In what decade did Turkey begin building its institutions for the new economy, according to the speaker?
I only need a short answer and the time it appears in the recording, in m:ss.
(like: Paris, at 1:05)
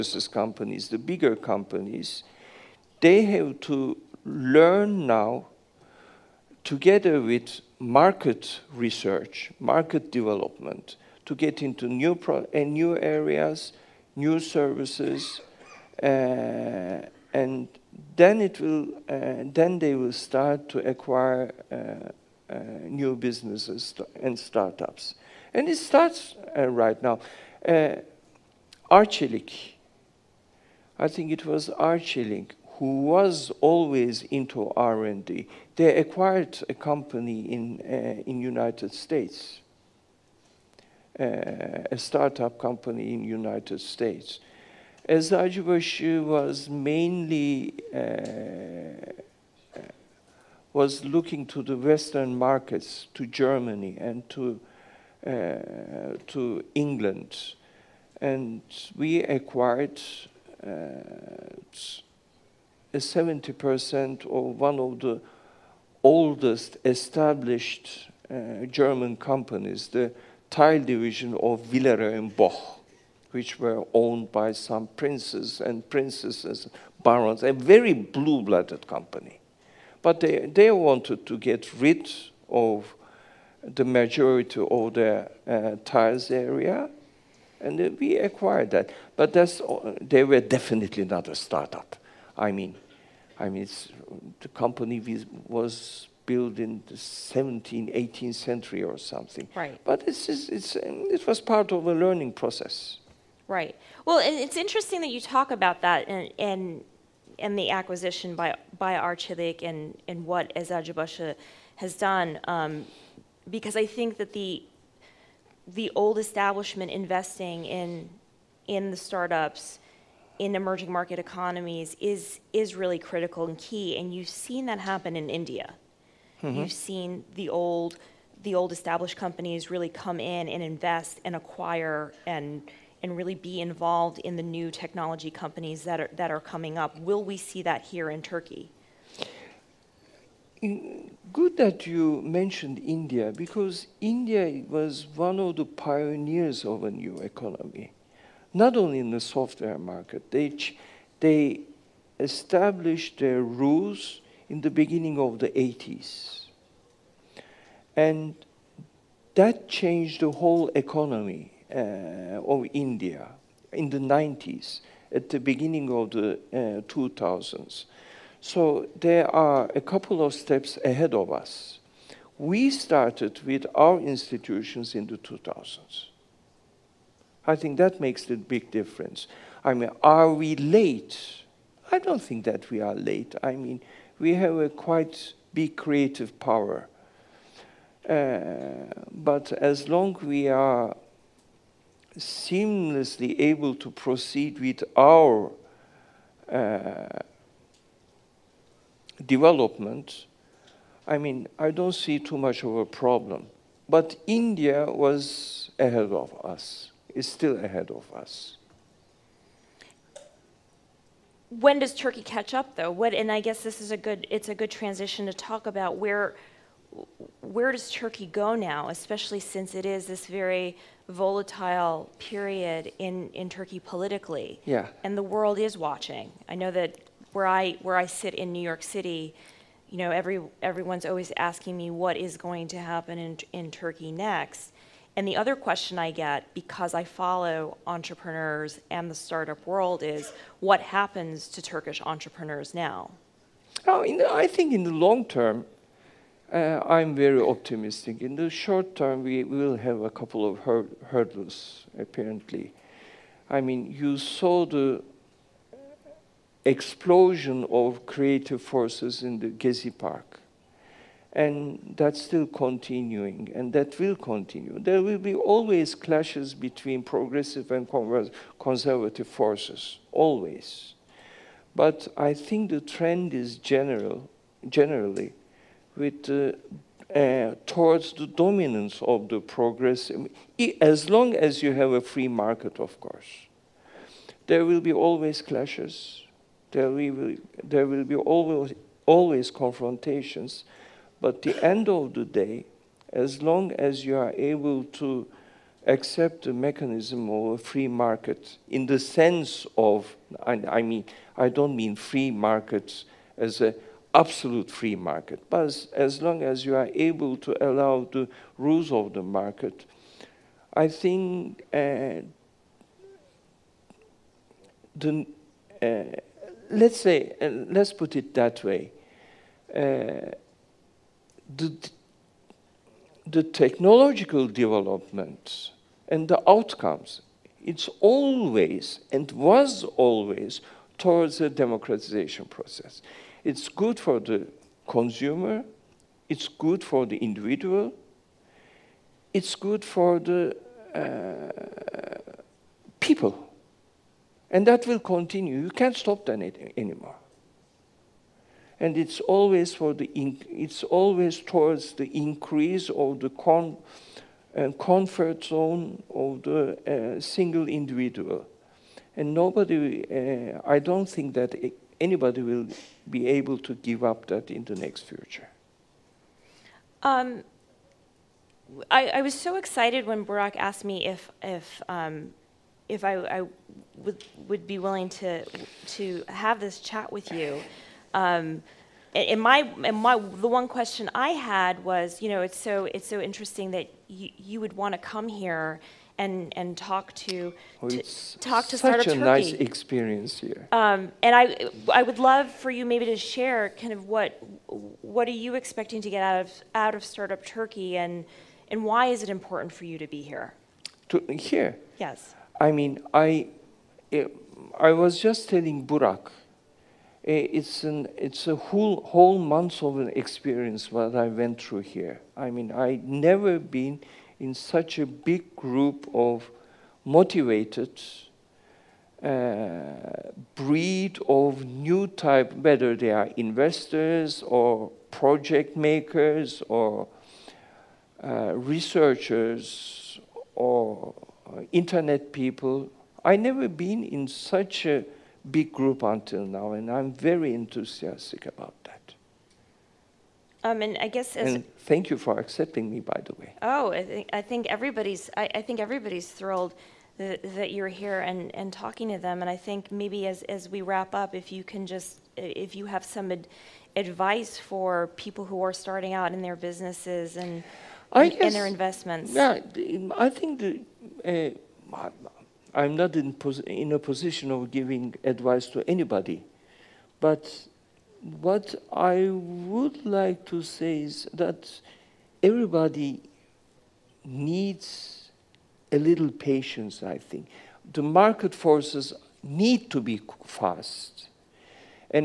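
2000s, at 2:54.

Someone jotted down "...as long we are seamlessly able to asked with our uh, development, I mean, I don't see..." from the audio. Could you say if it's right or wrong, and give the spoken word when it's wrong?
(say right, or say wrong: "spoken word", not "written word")
wrong: "proceed", not "asked".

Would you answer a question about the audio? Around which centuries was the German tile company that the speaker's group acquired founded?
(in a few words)
17th, 18th century.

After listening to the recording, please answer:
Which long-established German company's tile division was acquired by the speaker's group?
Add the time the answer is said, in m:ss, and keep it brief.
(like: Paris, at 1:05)
Villeroy and Boch, at 1:11.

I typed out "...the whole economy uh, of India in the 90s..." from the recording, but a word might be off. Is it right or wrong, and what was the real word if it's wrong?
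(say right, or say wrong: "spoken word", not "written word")
right.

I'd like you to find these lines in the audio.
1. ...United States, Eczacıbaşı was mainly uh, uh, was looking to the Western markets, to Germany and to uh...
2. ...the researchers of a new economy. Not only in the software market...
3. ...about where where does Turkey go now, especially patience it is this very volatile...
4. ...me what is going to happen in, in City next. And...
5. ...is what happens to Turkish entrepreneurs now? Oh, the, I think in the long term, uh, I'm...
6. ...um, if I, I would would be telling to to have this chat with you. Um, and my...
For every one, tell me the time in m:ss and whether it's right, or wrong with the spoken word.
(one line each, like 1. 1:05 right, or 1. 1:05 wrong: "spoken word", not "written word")
1. 0:43 right
2. 2:25 wrong: "pioneers", not "researchers"
3. 3:35 wrong: "since", not "patience"
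4. 3:51 wrong: "Turkey", not "City"
5. 4:00 right
6. 6:11 wrong: "willing", not "telling".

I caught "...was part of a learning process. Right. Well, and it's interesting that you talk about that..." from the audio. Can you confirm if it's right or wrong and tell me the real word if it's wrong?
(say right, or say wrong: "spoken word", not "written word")
right.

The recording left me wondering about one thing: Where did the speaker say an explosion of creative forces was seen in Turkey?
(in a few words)
Gezi Park.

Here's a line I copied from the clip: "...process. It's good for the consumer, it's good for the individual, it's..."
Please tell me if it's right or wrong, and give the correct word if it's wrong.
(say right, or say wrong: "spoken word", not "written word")
right.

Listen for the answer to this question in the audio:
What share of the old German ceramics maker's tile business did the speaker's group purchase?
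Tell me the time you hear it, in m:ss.
1:02.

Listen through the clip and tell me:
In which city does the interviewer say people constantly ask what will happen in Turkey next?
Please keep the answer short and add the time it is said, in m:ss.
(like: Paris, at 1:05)
New York City, at 3:48.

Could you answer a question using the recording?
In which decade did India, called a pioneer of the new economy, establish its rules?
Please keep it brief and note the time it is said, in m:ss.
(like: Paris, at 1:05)
1980s, at 2:35.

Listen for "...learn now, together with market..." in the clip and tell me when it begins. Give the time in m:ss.
0:04.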